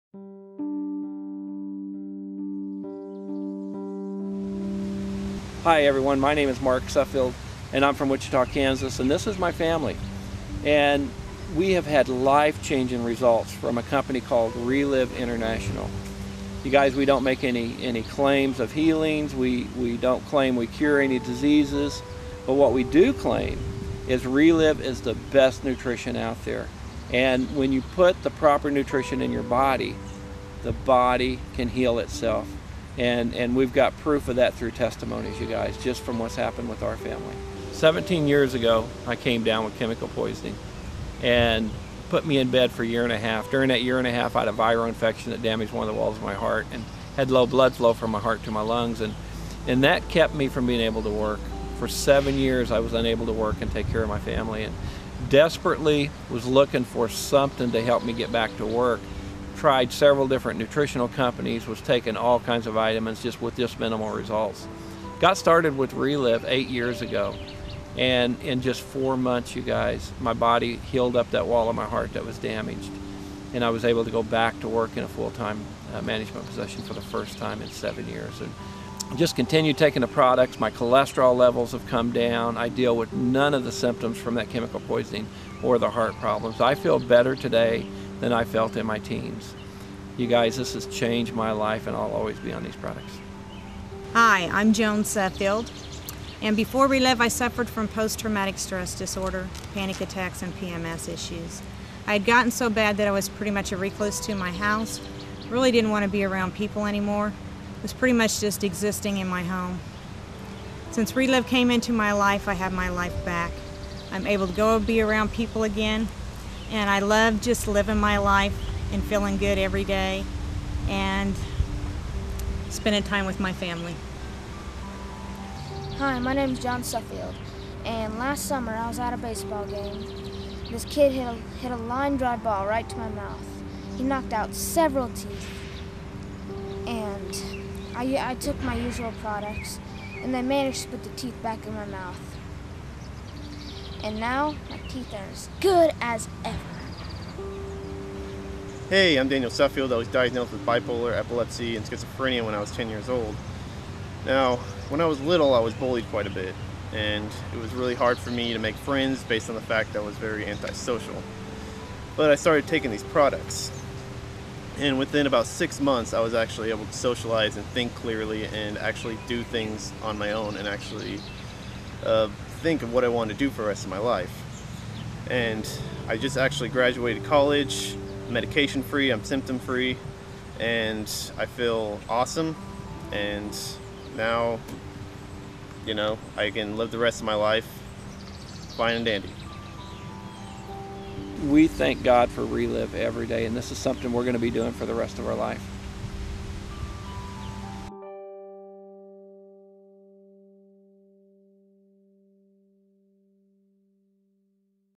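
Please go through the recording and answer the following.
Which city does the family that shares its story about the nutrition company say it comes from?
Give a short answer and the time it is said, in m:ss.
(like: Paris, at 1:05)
Wichita, at 0:08.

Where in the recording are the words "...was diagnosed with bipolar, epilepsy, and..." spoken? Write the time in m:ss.
2:29.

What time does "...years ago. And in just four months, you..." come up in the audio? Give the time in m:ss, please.
1:06.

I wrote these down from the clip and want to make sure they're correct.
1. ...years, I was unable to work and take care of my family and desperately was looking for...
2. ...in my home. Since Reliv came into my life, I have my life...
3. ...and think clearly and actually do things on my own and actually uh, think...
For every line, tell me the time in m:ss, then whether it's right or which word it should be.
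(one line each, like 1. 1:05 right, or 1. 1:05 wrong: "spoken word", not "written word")
1. 0:52 right
2. 1:49 right
3. 2:47 right.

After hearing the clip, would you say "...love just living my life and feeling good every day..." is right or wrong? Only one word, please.
right.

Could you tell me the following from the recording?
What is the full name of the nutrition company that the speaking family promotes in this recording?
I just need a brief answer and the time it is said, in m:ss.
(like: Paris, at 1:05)
Reliv International, at 0:14.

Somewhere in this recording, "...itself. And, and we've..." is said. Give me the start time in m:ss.
0:31.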